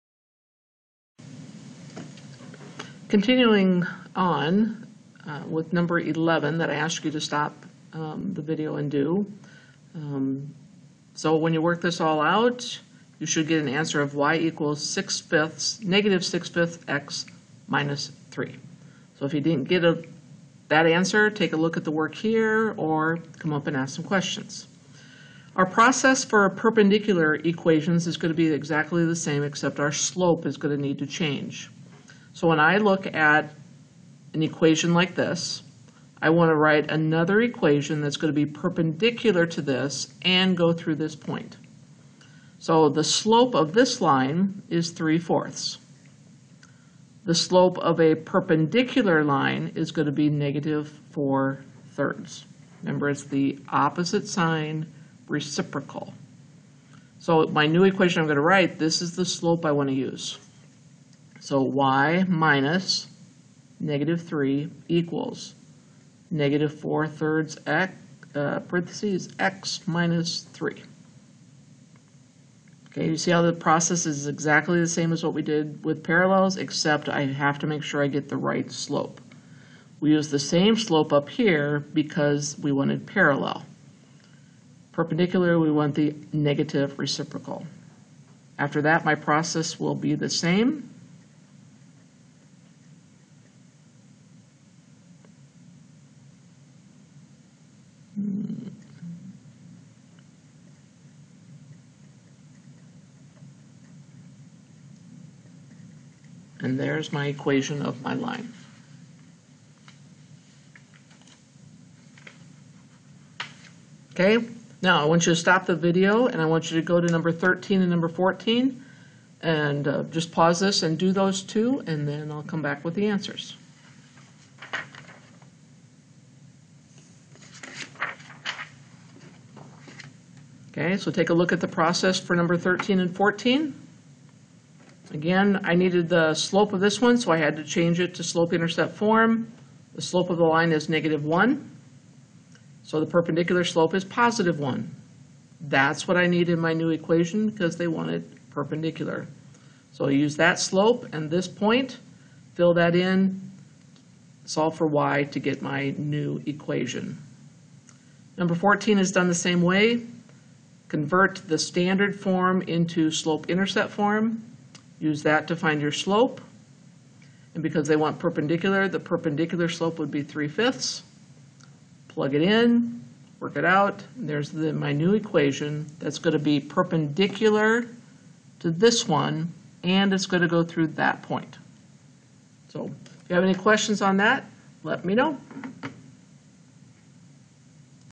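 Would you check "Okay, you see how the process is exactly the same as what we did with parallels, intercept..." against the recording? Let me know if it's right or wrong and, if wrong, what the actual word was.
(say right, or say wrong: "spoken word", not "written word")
wrong: "except", not "intercept".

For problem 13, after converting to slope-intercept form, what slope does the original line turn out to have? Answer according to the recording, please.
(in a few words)
-1.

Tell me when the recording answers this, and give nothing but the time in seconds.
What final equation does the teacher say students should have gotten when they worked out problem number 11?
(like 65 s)
15 s.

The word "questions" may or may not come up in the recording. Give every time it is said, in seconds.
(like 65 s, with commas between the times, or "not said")
24 s, 183 s.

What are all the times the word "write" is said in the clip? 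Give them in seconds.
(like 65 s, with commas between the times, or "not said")
36 s, 58 s.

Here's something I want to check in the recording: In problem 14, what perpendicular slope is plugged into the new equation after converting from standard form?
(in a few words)
3/5.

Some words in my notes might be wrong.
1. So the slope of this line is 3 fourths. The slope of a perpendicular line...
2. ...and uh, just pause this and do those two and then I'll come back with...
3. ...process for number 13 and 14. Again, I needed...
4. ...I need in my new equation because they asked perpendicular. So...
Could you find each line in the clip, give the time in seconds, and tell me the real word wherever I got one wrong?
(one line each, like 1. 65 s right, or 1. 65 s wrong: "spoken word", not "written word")
1. 42 s right
2. 119 s right
3. 131 s right
4. 146 s wrong: "wanted", not "asked".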